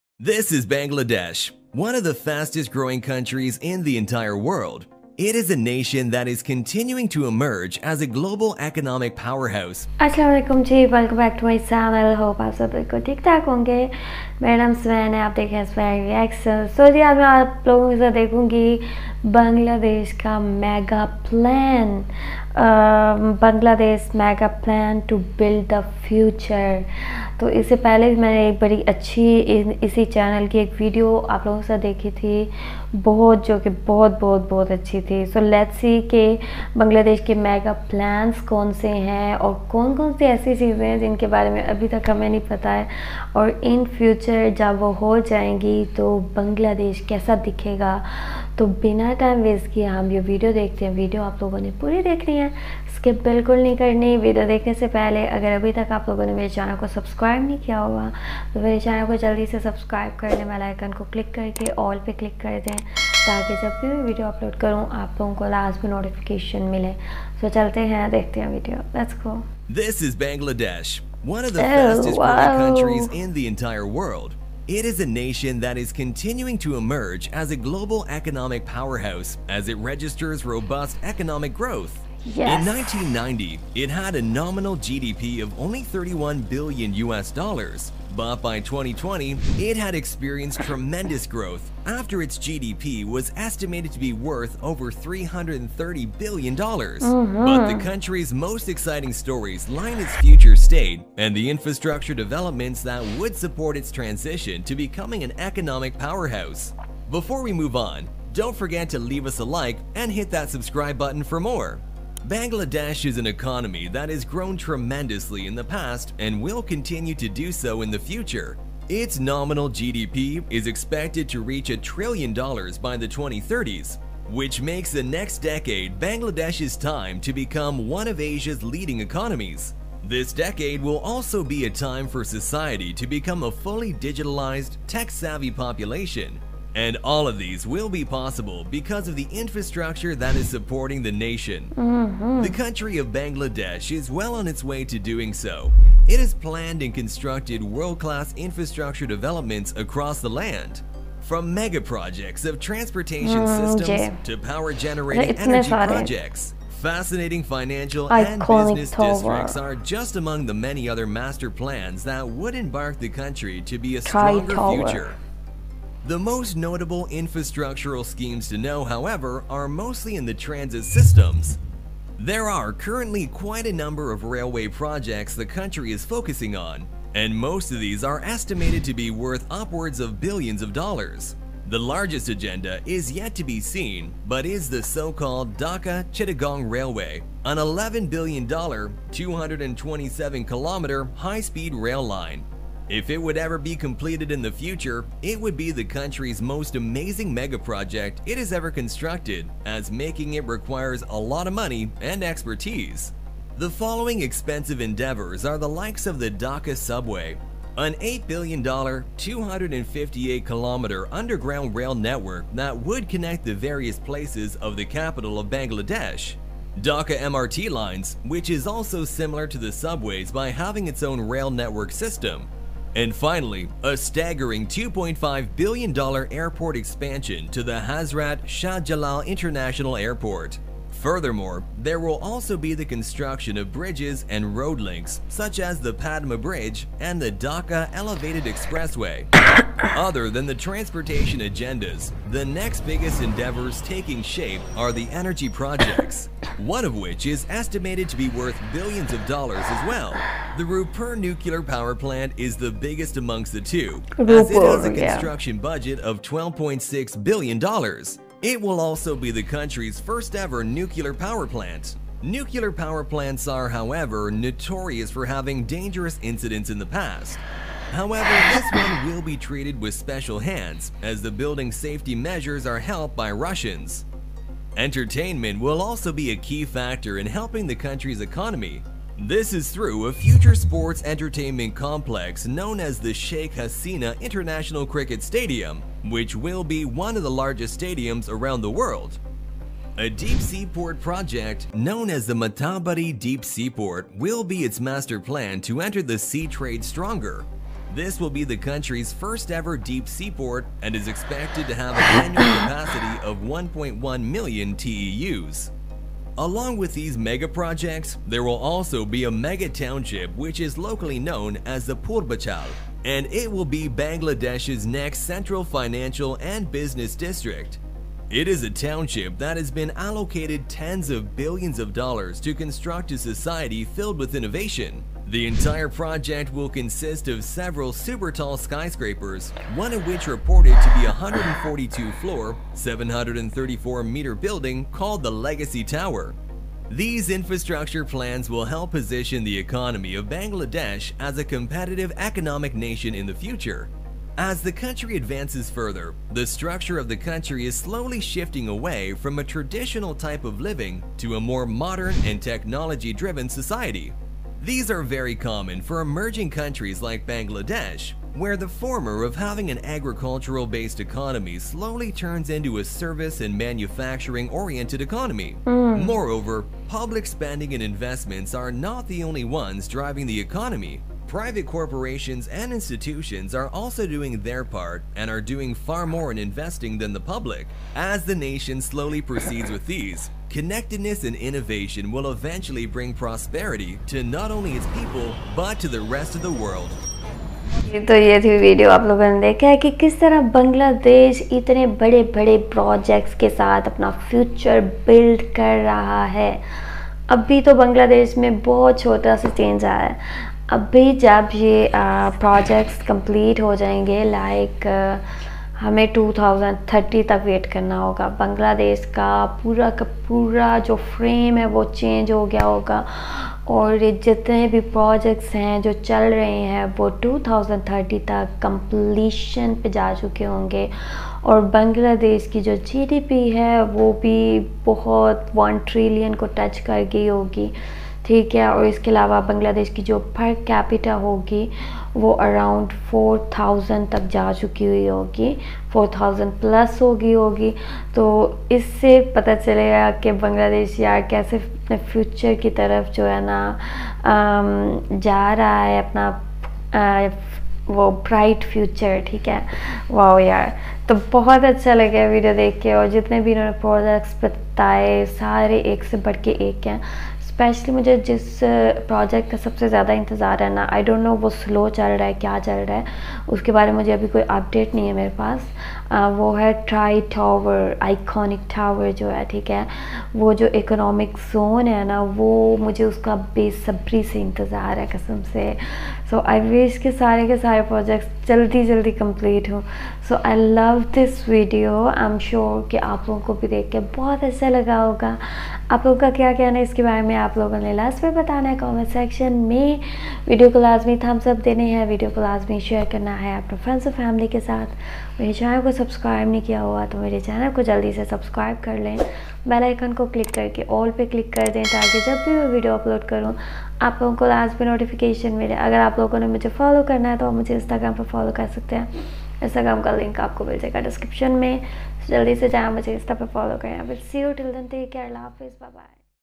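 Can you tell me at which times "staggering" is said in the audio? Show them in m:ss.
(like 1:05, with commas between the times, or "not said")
3:43.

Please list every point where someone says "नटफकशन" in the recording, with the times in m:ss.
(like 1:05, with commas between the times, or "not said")
1:05, 8:24.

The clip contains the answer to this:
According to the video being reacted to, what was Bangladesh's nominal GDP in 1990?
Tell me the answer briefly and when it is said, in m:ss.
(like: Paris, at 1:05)
31 billion US dollars, at 1:25.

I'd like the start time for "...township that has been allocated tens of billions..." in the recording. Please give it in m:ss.
5:18.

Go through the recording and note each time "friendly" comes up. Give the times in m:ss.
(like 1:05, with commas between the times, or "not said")
not said.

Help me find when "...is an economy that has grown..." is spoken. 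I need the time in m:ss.
1:53.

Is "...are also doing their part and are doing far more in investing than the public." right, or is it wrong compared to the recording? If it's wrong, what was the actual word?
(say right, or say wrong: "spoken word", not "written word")
right.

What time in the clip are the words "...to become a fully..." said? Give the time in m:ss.
2:12.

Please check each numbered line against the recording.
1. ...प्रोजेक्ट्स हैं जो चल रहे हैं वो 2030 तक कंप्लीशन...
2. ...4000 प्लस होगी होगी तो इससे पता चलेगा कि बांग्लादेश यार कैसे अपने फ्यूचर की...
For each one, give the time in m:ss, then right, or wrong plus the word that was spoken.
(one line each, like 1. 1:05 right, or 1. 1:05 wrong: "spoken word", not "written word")
1. 6:54 right
2. 7:15 right.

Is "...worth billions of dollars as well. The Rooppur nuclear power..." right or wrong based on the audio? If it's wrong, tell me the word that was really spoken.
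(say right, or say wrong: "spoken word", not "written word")
right.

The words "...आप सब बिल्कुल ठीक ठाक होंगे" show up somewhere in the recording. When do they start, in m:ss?
0:12.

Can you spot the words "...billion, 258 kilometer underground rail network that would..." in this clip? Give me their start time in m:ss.
3:28.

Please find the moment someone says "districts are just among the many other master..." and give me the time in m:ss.
2:39.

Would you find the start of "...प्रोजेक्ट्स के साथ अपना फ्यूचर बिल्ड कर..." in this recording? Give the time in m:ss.
6:32.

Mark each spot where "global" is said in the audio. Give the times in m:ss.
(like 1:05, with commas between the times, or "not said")
0:08, 1:17.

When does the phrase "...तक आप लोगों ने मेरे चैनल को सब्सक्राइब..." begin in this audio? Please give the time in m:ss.
0:55.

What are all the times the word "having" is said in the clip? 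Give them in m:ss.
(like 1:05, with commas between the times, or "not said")
3:40, 4:25, 5:59.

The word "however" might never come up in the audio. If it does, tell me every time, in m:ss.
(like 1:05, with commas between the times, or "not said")
2:48, 4:23, 4:27.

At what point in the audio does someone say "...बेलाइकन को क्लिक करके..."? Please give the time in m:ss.
1:00.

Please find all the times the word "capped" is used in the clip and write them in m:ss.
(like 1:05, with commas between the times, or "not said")
not said.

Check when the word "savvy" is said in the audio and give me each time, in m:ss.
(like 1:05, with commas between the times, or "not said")
2:14.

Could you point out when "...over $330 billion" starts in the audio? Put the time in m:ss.
1:34.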